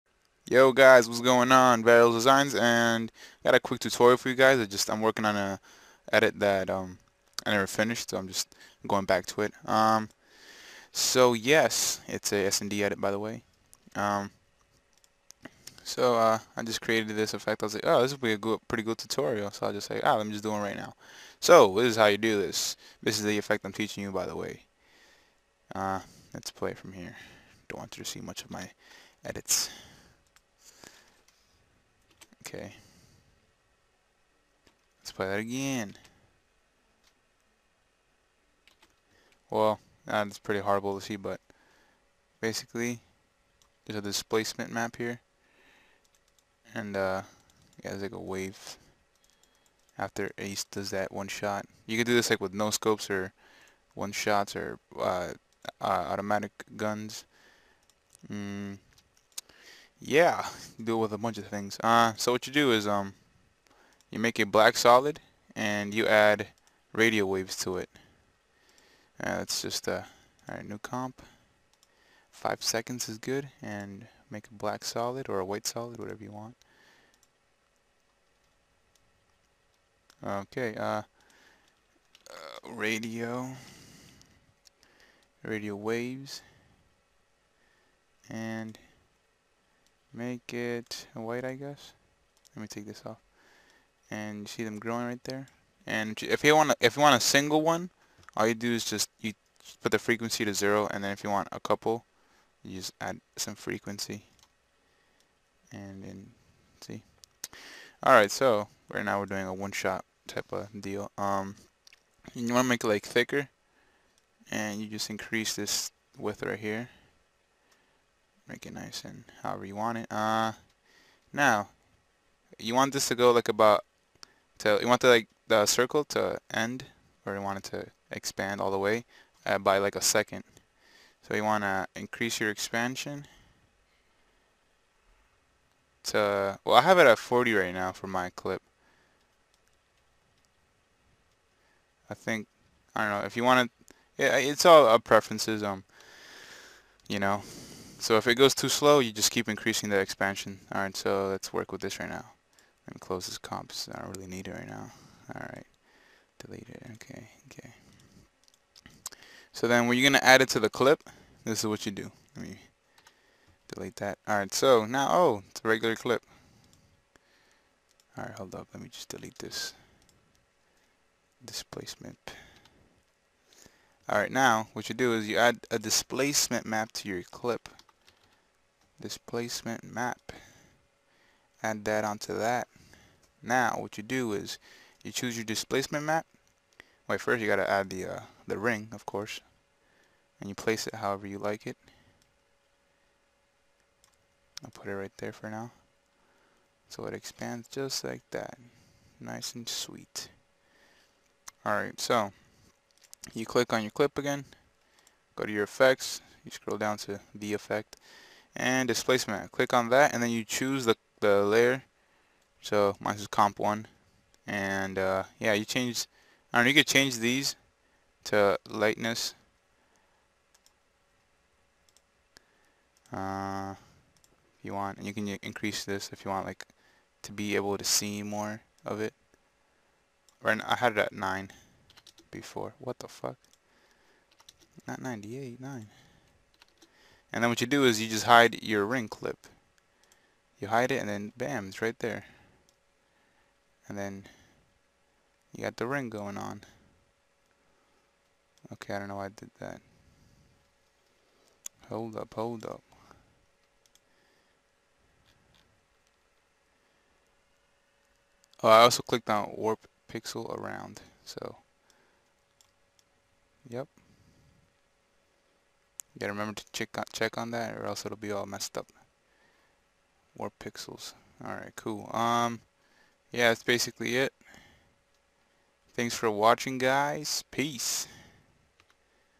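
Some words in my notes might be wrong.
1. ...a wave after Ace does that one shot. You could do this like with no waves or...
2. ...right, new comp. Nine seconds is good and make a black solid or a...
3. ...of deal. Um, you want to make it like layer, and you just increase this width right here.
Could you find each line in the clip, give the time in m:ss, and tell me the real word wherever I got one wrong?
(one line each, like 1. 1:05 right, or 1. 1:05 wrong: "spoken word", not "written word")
1. 0:48 wrong: "scopes", not "waves"
2. 1:10 wrong: "Five", not "Nine"
3. 1:50 wrong: "thicker", not "layer".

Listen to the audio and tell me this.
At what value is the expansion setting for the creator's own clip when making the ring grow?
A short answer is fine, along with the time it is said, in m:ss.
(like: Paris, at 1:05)
40, at 2:17.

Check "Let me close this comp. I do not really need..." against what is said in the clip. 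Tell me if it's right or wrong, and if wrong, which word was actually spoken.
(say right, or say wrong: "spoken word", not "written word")
right.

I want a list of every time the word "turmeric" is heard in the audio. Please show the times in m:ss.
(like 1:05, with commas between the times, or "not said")
not said.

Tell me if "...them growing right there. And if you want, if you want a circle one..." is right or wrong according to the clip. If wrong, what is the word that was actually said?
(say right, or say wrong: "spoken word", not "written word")
wrong: "single", not "circle".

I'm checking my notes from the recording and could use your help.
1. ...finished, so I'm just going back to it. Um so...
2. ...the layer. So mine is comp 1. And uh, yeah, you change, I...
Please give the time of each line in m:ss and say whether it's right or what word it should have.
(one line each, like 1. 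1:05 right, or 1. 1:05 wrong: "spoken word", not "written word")
1. 0:07 right
2. 3:31 right.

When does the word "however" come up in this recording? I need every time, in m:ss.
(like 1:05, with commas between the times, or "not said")
1:59, 3:10.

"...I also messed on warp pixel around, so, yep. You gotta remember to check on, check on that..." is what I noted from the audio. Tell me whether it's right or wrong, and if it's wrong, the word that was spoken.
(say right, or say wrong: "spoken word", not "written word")
wrong: "clicked", not "messed".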